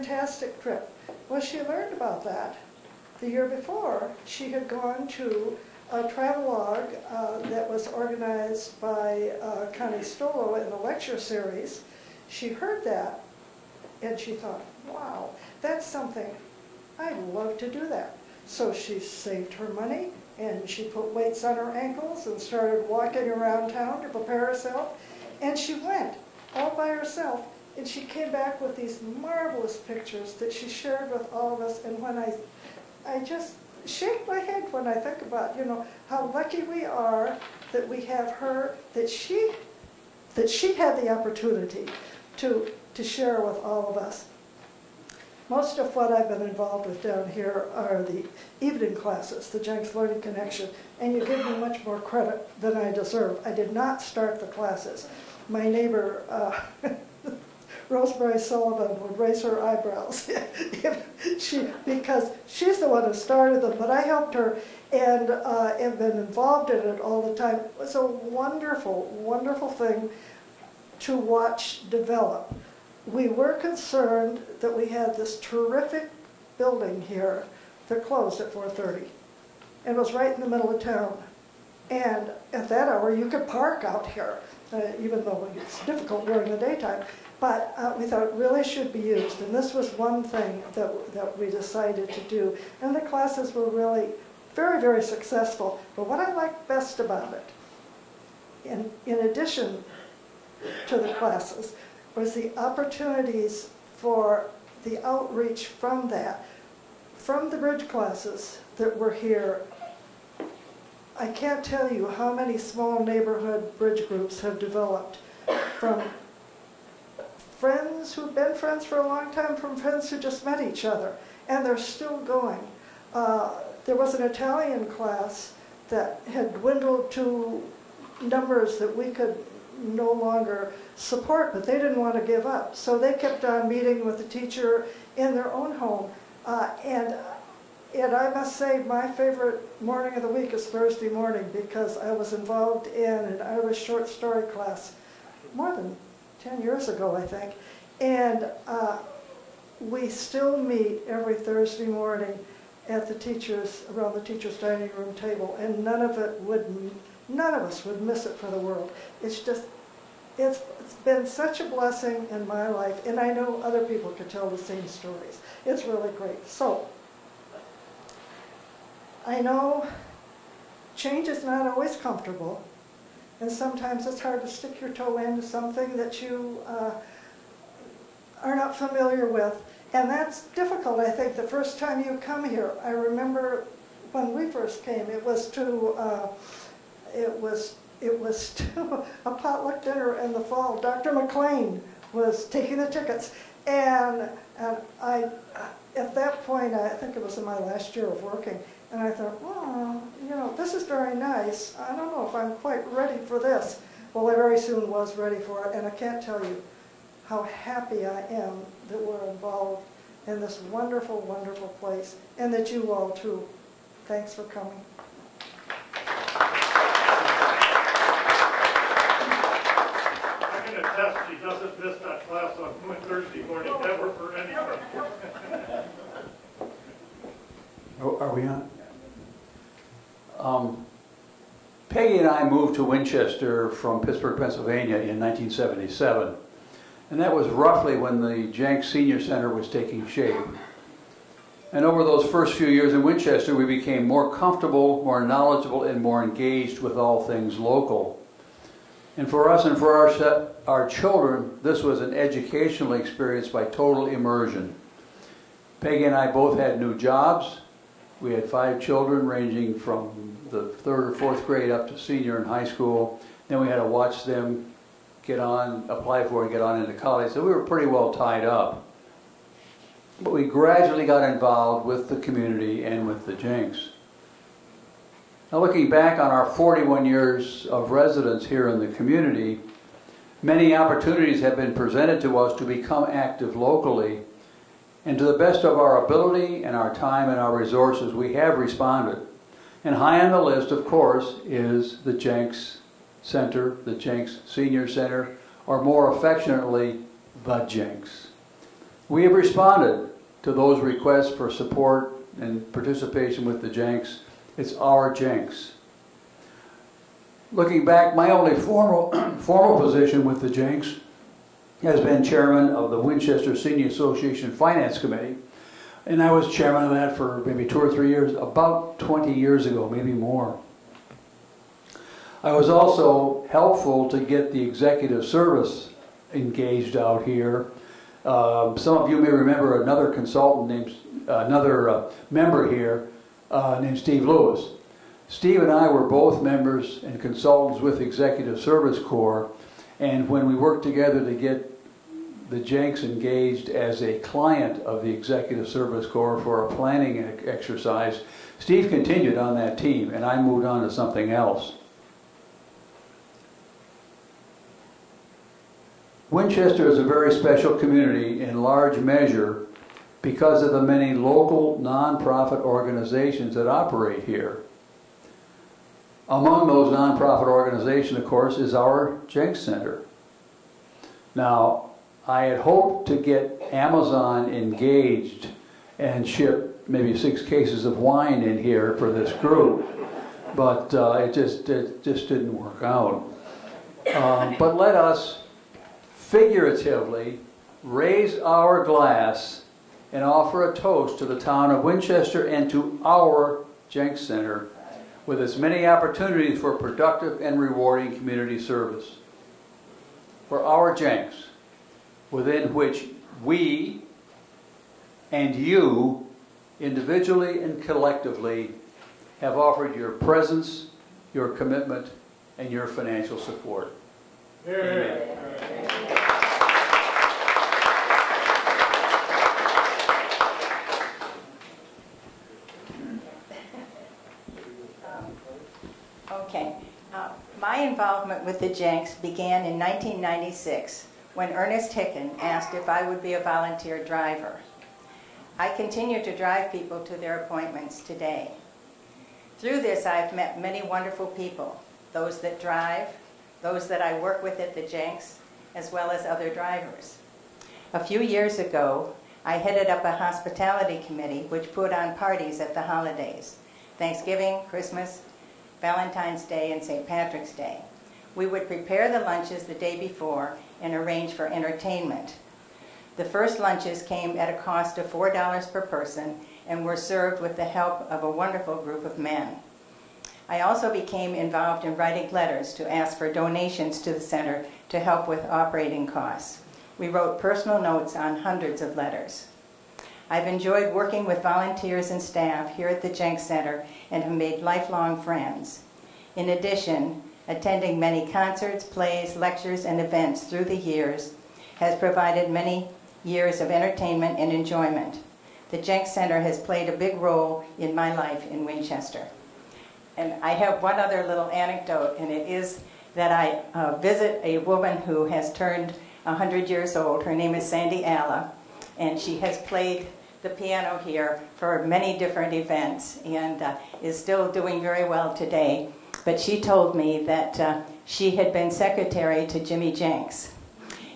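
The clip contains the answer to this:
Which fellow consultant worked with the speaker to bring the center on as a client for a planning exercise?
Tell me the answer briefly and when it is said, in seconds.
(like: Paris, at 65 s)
Steve Lewis, at 333 s.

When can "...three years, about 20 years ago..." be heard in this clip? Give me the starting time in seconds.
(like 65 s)
317 s.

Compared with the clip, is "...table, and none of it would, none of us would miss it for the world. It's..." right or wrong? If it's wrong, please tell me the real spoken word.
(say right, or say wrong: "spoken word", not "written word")
right.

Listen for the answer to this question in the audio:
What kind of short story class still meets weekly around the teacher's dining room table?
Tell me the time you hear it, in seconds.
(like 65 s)
143 s.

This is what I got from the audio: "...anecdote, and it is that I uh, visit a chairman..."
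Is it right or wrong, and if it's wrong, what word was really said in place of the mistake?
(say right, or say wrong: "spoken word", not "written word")
wrong: "woman", not "chairman".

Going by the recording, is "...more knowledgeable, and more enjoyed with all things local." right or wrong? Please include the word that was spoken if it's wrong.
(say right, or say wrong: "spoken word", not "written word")
wrong: "engaged", not "enjoyed".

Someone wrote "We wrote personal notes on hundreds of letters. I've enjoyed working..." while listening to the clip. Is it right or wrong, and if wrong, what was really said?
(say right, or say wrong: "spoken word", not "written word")
right.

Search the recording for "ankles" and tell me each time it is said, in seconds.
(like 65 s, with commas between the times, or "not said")
21 s.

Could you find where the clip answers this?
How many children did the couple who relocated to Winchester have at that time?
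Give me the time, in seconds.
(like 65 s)
258 s.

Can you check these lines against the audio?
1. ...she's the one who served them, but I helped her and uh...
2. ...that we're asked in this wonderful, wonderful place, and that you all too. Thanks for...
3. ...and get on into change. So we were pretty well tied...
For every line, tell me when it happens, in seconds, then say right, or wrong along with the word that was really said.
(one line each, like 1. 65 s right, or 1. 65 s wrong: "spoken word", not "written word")
1. 62 s wrong: "started", not "served"
2. 208 s wrong: "involved", not "asked"
3. 266 s wrong: "college", not "change".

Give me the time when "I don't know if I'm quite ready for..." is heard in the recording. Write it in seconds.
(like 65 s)
201 s.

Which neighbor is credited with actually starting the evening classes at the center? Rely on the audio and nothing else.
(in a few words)
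Rosemary Sullivan.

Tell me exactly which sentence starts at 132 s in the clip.
So they kept on meeting with the teacher in their own home.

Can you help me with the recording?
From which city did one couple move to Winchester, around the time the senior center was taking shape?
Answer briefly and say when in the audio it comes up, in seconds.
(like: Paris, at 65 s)
Pittsburgh, at 233 s.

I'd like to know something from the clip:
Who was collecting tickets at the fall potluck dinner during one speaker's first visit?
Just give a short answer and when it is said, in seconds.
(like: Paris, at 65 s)
Dr. McLean, at 190 s.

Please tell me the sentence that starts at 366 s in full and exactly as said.
Among those nonprofit organizations, of course, is our Jenks Center.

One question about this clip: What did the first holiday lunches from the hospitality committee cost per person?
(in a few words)
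$4.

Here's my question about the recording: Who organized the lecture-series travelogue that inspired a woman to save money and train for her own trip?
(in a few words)
Connie Stolo.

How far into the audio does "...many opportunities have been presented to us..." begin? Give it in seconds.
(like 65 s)
280 s.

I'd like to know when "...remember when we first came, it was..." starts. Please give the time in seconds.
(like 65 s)
182 s.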